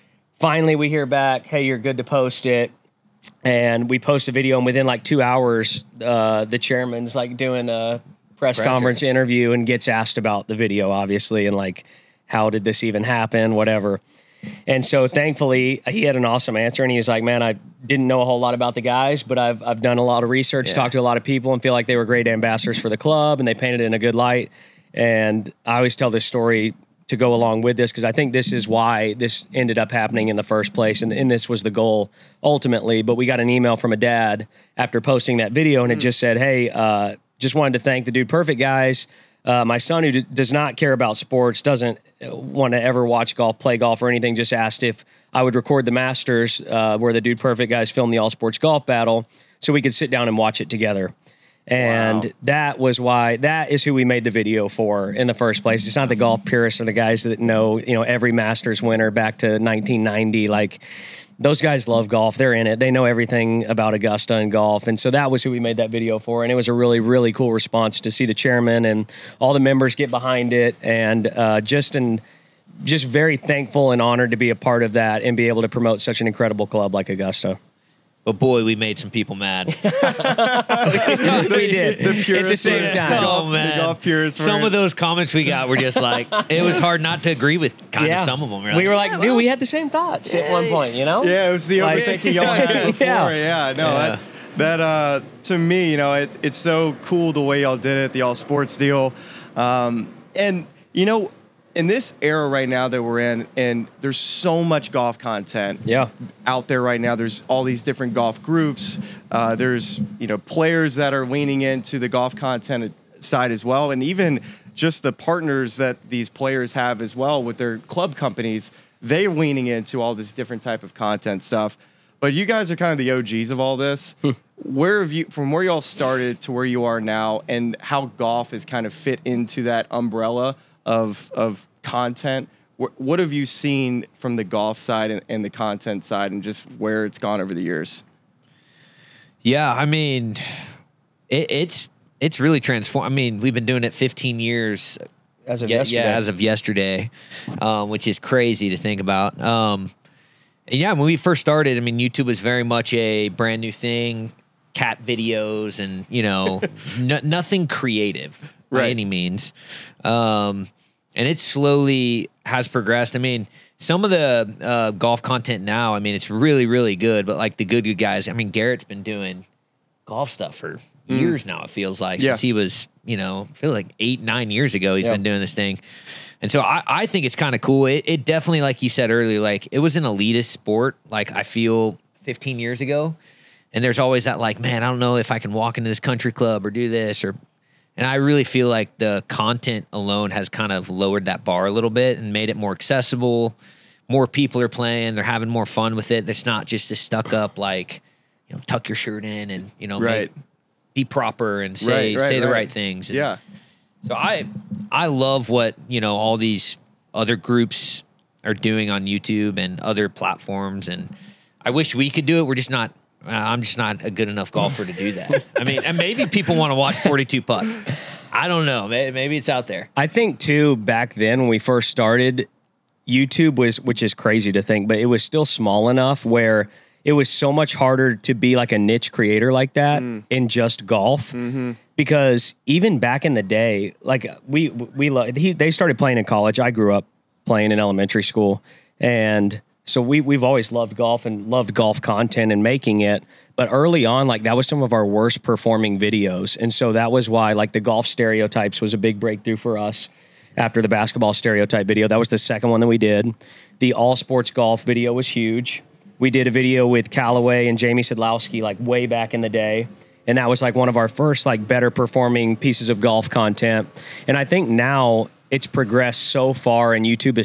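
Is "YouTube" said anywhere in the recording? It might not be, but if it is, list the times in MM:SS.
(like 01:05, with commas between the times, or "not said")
02:31, 03:29, 03:43.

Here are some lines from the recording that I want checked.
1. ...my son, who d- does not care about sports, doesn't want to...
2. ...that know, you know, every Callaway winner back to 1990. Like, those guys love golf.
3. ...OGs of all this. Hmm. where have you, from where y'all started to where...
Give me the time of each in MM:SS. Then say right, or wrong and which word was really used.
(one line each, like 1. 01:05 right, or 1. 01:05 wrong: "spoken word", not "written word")
1. 00:39 right
2. 00:57 wrong: "Masters", not "Callaway"
3. 02:03 right.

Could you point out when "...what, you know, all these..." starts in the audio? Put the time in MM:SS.
03:25.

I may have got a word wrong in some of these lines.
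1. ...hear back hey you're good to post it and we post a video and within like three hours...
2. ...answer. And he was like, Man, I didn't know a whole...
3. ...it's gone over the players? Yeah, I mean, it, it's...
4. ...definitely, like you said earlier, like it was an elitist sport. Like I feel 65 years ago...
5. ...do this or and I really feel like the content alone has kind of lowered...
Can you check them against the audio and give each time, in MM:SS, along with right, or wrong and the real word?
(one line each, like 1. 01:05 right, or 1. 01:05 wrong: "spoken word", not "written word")
1. 00:00 wrong: "two", not "three"
2. 00:16 right
3. 02:17 wrong: "years", not "players"
4. 02:58 wrong: "15", not "65"
5. 03:06 right.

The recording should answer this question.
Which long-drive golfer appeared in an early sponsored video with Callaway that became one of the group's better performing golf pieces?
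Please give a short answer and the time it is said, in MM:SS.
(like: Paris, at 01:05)
Jamie Sadlowski, at 04:17.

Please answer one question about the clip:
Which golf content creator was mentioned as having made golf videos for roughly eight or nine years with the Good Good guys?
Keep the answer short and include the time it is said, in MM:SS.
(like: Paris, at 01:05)
Garrett, at 02:48.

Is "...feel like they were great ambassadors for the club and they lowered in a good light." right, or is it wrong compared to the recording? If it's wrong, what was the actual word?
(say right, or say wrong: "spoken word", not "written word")
wrong: "painted", not "lowered".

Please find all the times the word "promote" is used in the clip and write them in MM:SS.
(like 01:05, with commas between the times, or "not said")
01:15.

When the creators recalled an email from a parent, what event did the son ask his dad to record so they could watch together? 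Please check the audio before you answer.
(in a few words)
The Masters.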